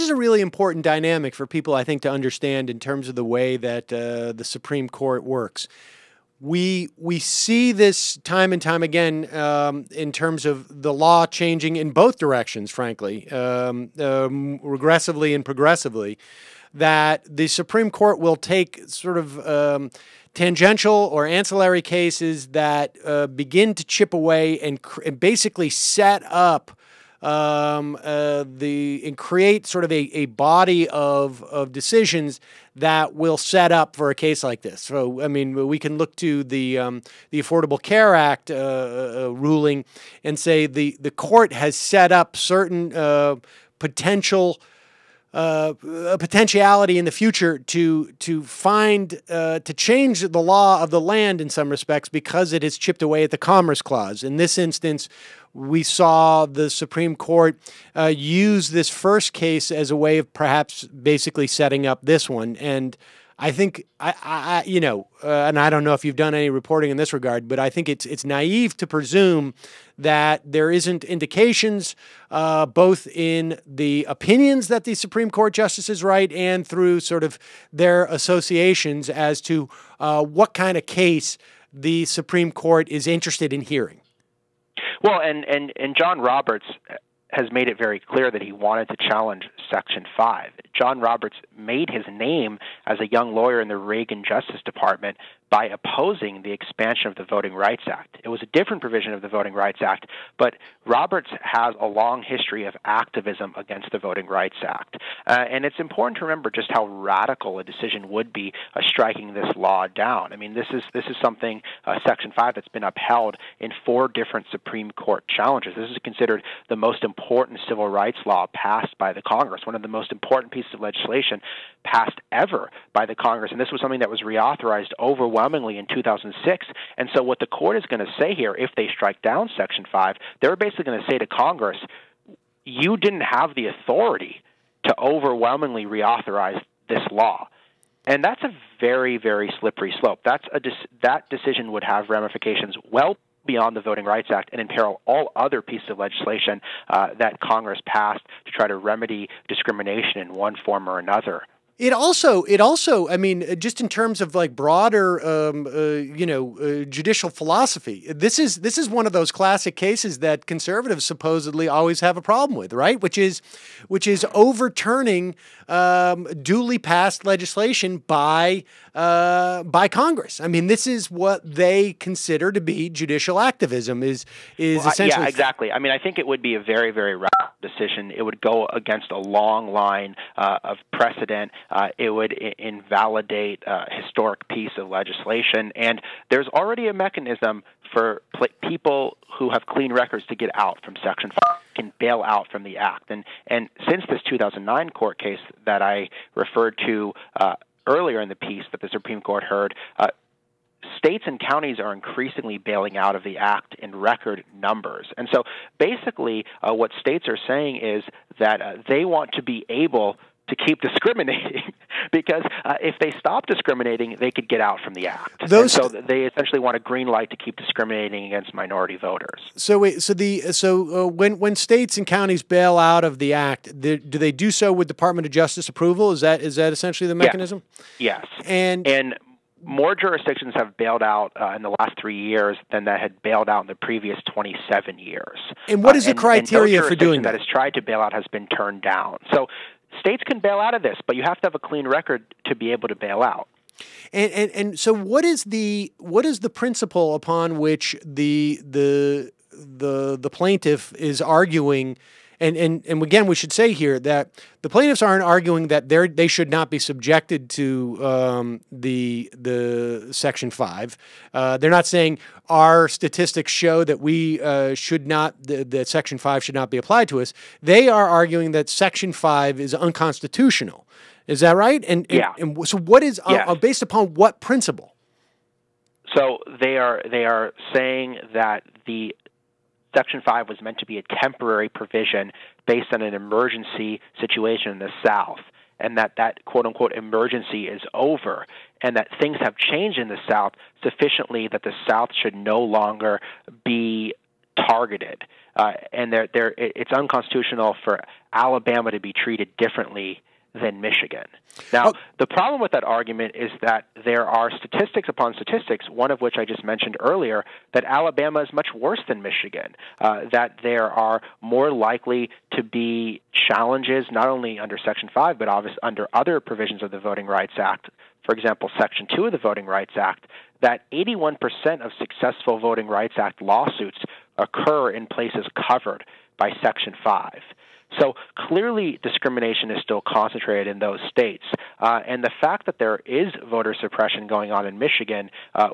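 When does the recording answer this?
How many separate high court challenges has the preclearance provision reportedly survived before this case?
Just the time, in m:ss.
1:53.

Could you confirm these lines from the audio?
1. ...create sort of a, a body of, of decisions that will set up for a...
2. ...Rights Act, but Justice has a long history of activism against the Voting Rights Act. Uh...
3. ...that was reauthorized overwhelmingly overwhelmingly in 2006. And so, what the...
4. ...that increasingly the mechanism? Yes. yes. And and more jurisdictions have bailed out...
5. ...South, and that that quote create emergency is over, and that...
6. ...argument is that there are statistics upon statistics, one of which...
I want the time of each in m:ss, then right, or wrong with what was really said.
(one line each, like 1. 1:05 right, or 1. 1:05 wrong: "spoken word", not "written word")
1. 0:29 right
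2. 1:39 wrong: "Roberts", not "Justice"
3. 2:03 right
4. 3:46 wrong: "essentially", not "increasingly"
5. 4:45 wrong: "unquote", not "create"
6. 5:02 right.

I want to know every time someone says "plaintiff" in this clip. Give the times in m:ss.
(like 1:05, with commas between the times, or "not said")
4:10, 4:14.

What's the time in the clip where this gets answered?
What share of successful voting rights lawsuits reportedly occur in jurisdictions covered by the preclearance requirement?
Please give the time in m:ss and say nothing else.
5:20.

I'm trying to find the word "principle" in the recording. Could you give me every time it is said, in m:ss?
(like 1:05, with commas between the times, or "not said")
4:06, 4:34.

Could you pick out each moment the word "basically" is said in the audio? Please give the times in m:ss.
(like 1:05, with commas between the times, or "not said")
0:25, 1:00, 2:10, 3:25.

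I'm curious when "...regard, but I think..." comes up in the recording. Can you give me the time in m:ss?
1:07.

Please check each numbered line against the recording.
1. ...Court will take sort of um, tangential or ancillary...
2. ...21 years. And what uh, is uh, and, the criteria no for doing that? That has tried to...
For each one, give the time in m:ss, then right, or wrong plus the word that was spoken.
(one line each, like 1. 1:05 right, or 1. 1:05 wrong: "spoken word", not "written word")
1. 0:17 right
2. 3:54 wrong: "27", not "21".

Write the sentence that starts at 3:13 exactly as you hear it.
And and since this 2009 court case that I referred to.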